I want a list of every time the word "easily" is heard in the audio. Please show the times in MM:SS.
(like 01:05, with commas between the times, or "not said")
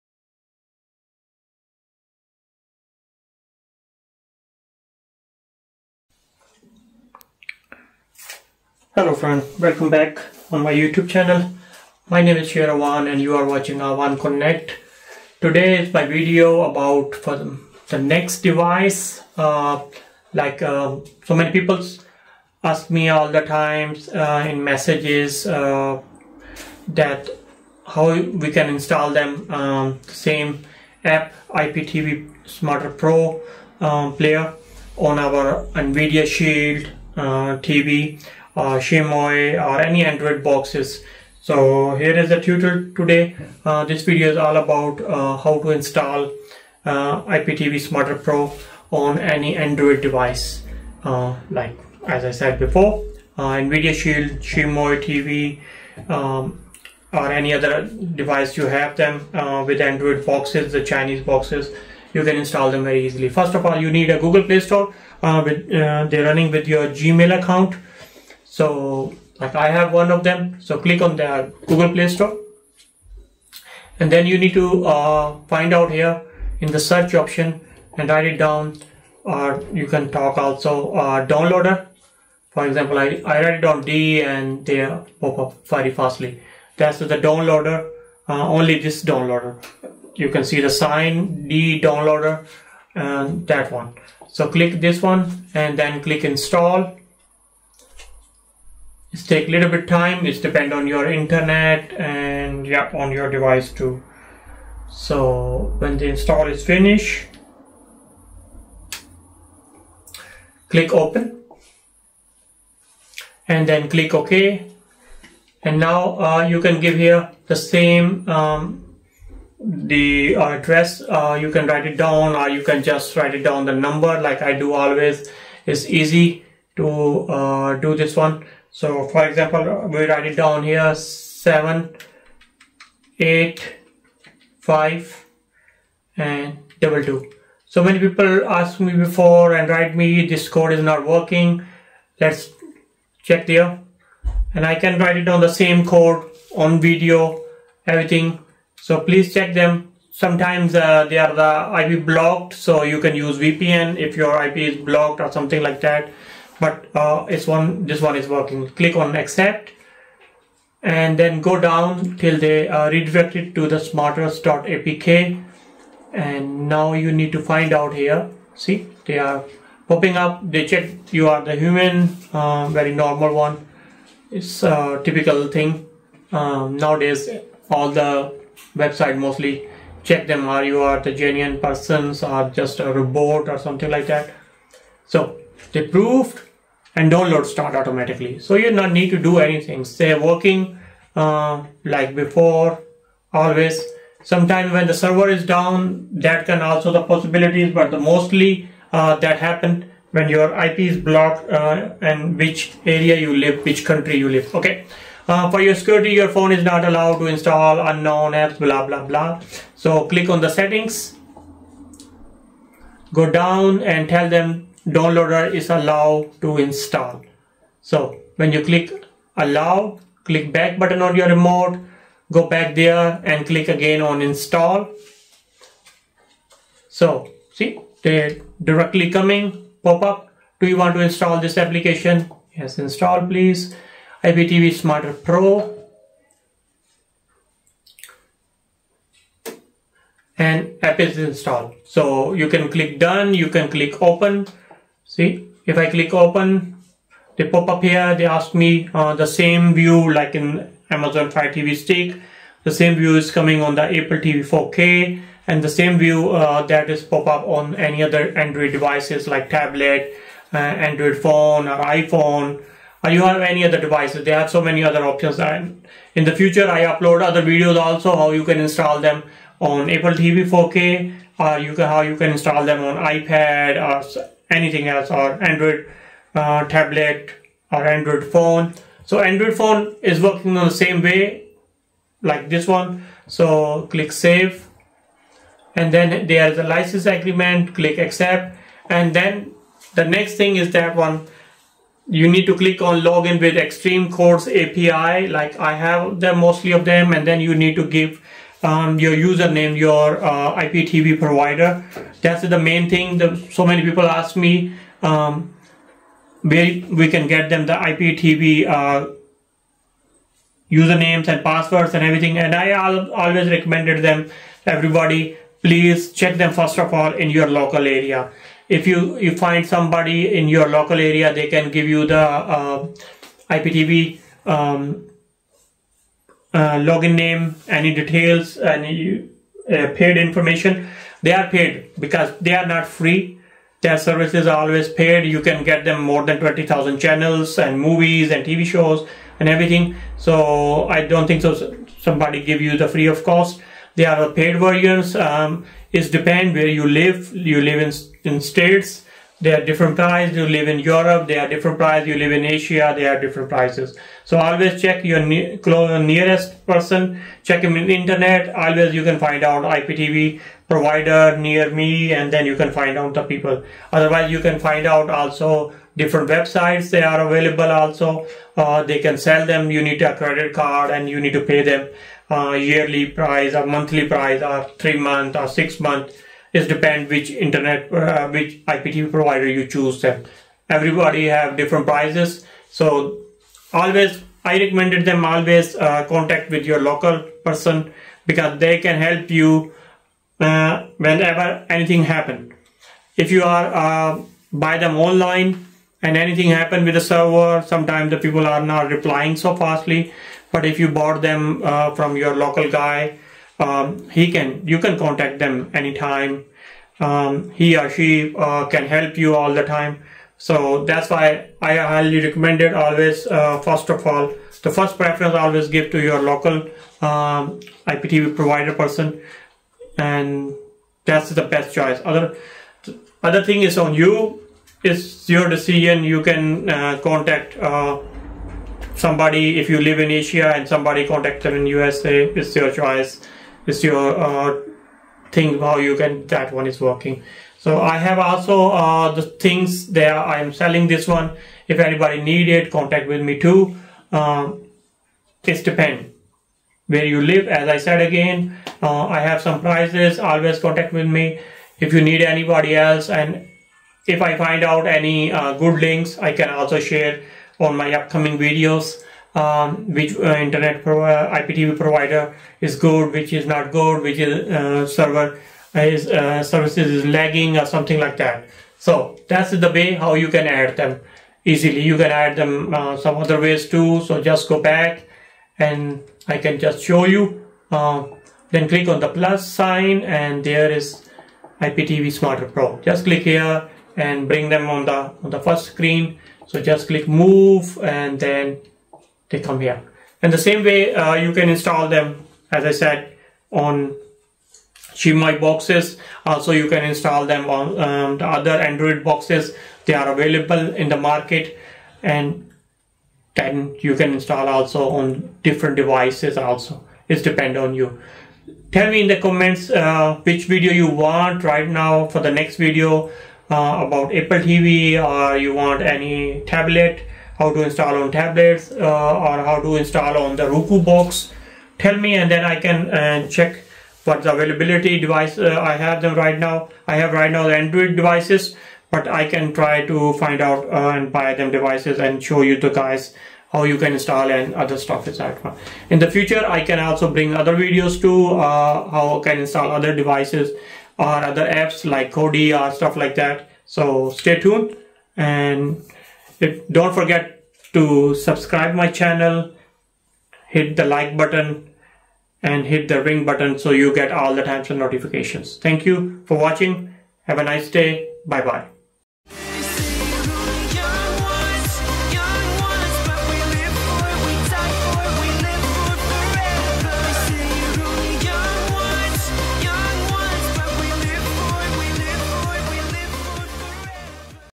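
01:03, 07:51.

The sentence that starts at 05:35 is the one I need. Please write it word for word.
You can get them more than 20,000 channels and movies and TV shows and everything.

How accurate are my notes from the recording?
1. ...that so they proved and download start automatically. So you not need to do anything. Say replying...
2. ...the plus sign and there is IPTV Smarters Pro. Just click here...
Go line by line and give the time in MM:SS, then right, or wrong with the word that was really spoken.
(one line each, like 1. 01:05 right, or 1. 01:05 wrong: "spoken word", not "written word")
1. 03:04 wrong: "working", not "replying"
2. 07:58 right.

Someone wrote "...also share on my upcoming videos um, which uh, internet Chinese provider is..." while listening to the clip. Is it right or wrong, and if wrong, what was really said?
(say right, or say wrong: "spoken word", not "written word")
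wrong: "IPTV", not "Chinese".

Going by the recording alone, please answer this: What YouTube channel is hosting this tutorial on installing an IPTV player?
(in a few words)
Awan Connect.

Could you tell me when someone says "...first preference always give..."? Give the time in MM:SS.
06:54.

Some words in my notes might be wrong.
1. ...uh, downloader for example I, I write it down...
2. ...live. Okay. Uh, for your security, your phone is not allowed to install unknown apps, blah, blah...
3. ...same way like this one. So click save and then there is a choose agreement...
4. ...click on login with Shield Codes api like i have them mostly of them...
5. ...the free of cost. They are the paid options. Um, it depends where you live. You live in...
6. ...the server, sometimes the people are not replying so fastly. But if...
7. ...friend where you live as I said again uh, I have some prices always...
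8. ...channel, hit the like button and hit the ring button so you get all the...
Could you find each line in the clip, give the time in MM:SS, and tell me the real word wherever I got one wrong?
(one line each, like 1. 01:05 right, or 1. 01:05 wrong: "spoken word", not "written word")
1. 01:20 right
2. 03:24 right
3. 04:40 wrong: "license", not "choose"
4. 04:52 wrong: "Xtream", not "Shield"
5. 05:42 wrong: "versions", not "options"
6. 06:36 right
7. 07:25 wrong: "depend", not "friend"
8. 09:08 right.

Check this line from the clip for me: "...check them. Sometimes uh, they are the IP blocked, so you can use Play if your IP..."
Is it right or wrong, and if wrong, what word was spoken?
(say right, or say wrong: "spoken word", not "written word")
wrong: "VPN", not "Play".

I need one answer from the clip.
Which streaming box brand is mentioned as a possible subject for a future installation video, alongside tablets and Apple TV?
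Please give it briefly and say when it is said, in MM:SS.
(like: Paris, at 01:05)
Roku, at 08:40.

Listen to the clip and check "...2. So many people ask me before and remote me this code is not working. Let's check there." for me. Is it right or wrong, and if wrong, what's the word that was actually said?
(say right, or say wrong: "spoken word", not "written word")
wrong: "write", not "remote".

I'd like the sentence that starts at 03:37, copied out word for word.
So when you click allow, click back button on your remote, go back there and click again on install.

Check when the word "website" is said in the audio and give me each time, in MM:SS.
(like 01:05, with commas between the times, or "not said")
02:58, 06:06.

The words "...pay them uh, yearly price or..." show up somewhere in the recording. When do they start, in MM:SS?
06:11.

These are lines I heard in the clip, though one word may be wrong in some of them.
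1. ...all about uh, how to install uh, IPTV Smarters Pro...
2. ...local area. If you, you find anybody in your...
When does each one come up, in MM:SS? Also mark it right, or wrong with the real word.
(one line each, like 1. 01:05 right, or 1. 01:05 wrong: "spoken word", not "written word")
1. 00:44 right
2. 05:17 wrong: "somebody", not "anybody".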